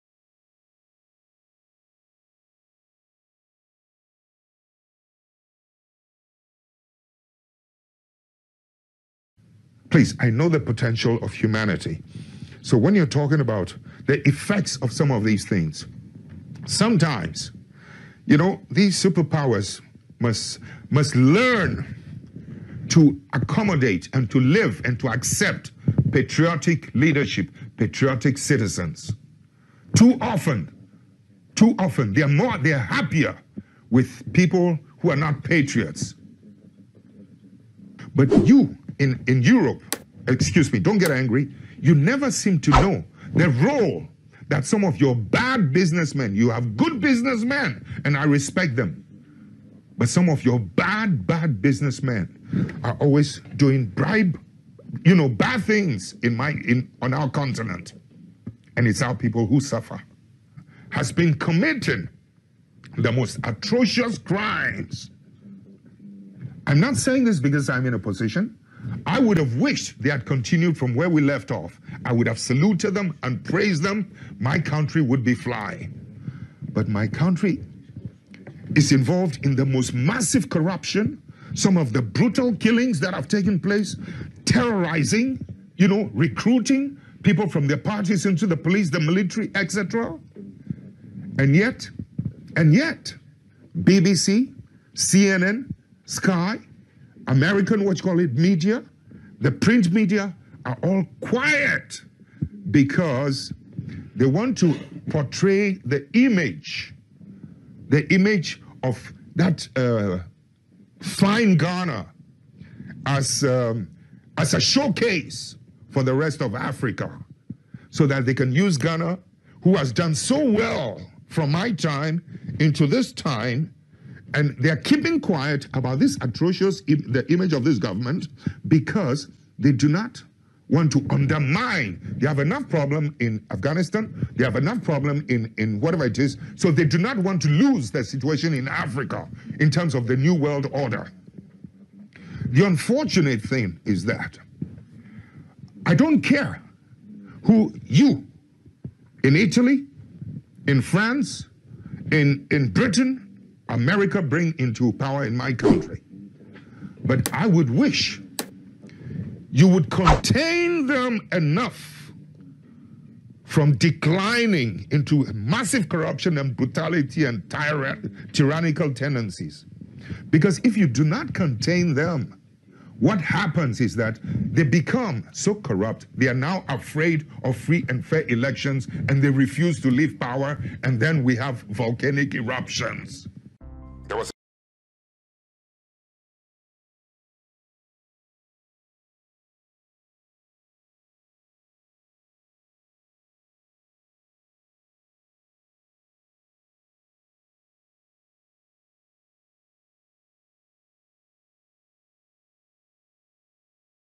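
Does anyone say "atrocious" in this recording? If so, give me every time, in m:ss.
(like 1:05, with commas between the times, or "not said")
1:03, 2:06.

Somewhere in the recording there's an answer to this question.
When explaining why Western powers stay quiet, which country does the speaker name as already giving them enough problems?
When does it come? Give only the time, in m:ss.
2:13.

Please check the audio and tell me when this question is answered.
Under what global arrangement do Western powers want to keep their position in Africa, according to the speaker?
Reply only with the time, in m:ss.
2:20.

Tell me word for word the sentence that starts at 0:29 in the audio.
Too often, too often, they're more, they're happier with people who are not patriots.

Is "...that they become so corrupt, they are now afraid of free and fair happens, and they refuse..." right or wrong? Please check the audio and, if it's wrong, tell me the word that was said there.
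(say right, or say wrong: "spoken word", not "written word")
wrong: "elections", not "happens".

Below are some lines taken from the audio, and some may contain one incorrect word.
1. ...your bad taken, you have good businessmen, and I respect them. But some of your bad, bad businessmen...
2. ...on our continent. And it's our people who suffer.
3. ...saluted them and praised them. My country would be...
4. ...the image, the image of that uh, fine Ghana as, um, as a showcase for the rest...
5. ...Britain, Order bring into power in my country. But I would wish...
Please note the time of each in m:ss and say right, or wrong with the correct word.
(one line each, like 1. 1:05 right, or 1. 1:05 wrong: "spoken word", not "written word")
1. 0:45 wrong: "businessmen", not "taken"
2. 0:57 right
3. 1:12 right
4. 1:45 right
5. 2:32 wrong: "America", not "Order".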